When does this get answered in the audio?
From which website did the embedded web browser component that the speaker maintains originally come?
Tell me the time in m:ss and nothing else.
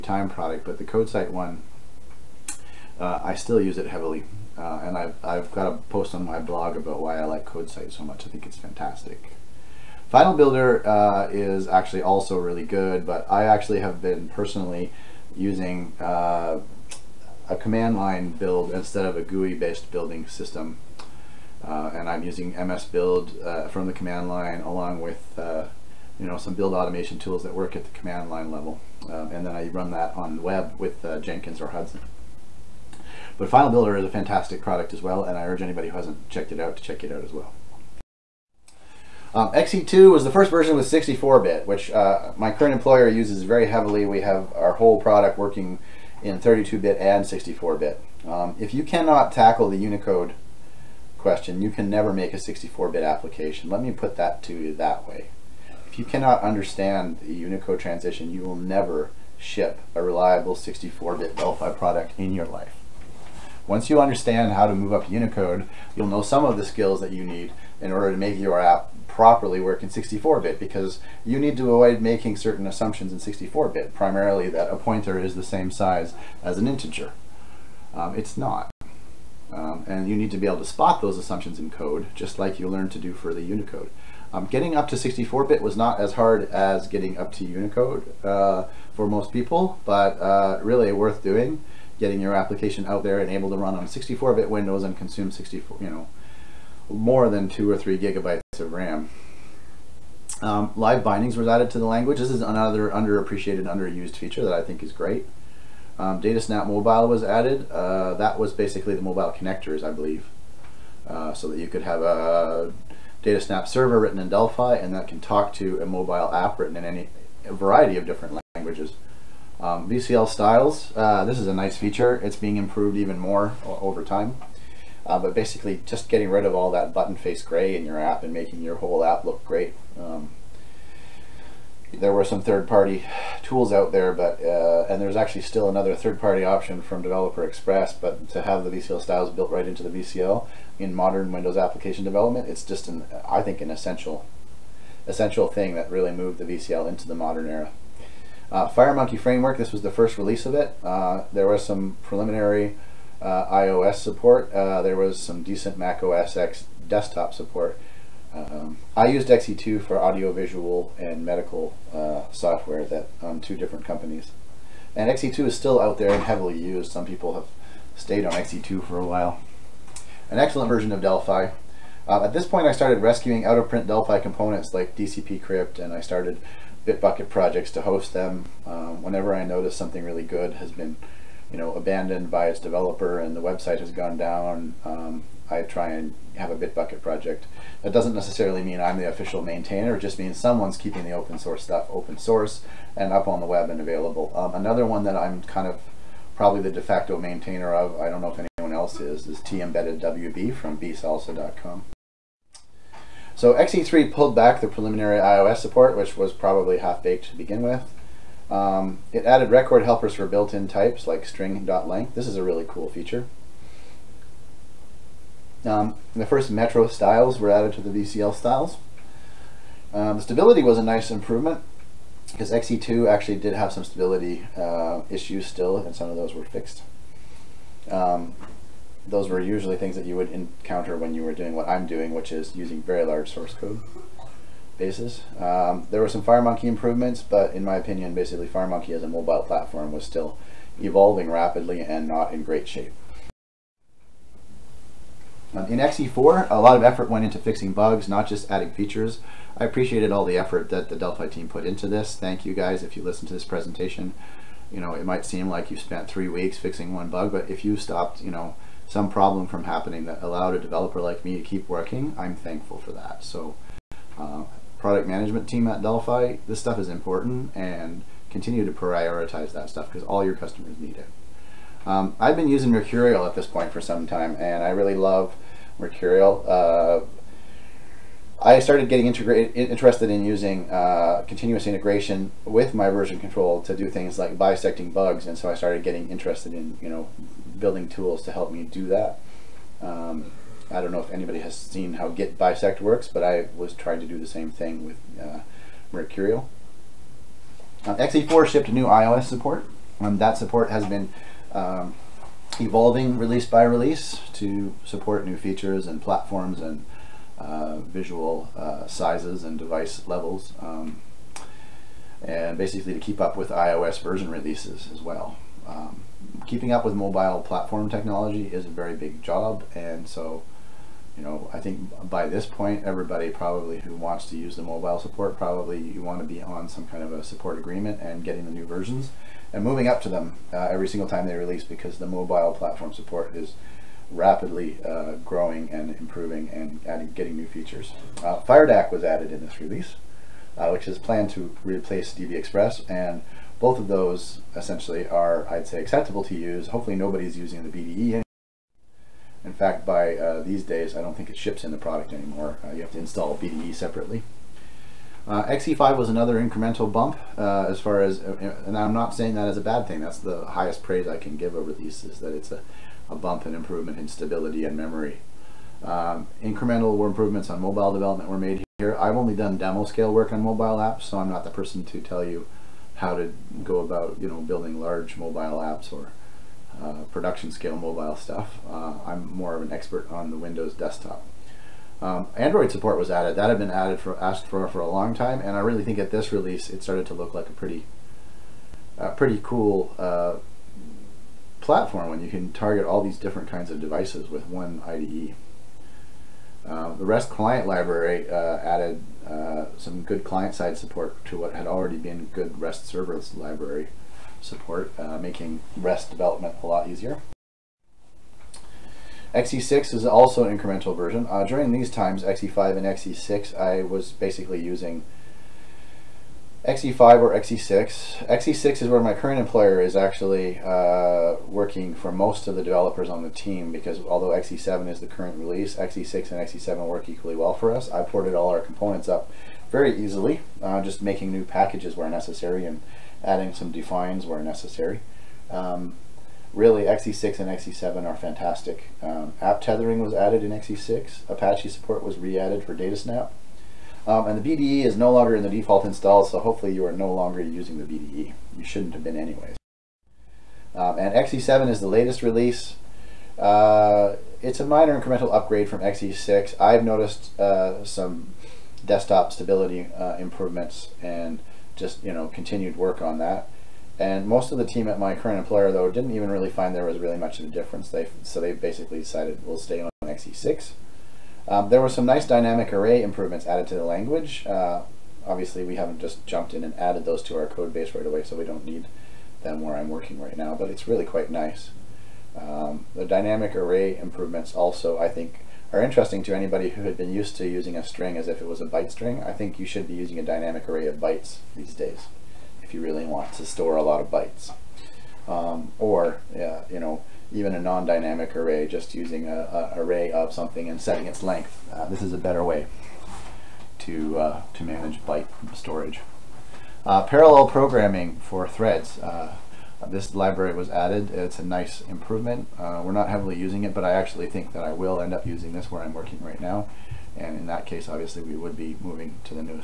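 3:20.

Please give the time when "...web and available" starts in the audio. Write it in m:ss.
3:13.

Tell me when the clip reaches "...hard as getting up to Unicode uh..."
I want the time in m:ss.
1:26.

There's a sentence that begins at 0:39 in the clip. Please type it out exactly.
Um, XE2 was the first version with 64-bit, which uh, my current employer uses very heavily.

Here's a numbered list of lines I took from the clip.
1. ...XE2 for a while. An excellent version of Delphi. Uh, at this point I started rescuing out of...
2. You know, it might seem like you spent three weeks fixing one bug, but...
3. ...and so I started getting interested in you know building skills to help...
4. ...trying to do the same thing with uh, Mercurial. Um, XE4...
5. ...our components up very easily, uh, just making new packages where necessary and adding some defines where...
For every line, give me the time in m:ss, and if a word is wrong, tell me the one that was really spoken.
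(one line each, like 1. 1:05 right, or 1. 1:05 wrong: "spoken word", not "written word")
1. 2:48 right
2. 4:14 right
3. 4:45 wrong: "tools", not "skills"
4. 4:53 right
5. 7:08 right.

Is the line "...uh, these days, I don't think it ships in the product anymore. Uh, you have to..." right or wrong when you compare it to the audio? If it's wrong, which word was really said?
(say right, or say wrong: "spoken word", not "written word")
right.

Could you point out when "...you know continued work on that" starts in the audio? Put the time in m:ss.
7:42.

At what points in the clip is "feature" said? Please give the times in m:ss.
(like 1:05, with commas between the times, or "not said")
1:44, 2:01, 3:32, 4:08, 5:05, 5:37.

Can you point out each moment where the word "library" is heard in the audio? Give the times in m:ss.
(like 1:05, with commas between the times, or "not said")
6:37, 6:43, 8:30.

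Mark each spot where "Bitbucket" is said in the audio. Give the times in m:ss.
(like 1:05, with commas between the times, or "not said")
2:56, 3:06.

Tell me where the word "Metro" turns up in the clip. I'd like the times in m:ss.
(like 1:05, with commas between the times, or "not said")
3:36.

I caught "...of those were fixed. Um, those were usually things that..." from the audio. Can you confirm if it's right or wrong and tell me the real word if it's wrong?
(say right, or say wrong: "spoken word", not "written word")
right.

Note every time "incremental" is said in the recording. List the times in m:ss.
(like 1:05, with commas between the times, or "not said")
5:56, 6:06, 6:50, 7:34.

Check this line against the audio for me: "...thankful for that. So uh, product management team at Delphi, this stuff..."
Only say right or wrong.
right.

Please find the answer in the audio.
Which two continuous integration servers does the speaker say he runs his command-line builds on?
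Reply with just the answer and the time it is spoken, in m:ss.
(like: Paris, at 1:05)
Jenkins or Hudson, at 0:31.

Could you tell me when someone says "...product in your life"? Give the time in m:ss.
1:01.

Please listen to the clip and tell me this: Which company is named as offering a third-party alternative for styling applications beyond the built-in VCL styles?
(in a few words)
Developer Express.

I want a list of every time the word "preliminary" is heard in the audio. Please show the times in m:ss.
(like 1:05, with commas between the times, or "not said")
2:32, 3:24.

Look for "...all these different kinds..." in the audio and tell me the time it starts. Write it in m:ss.
6:32.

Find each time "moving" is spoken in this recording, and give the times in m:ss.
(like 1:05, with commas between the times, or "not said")
5:29, 8:38.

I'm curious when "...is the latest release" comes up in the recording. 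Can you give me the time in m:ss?
7:31.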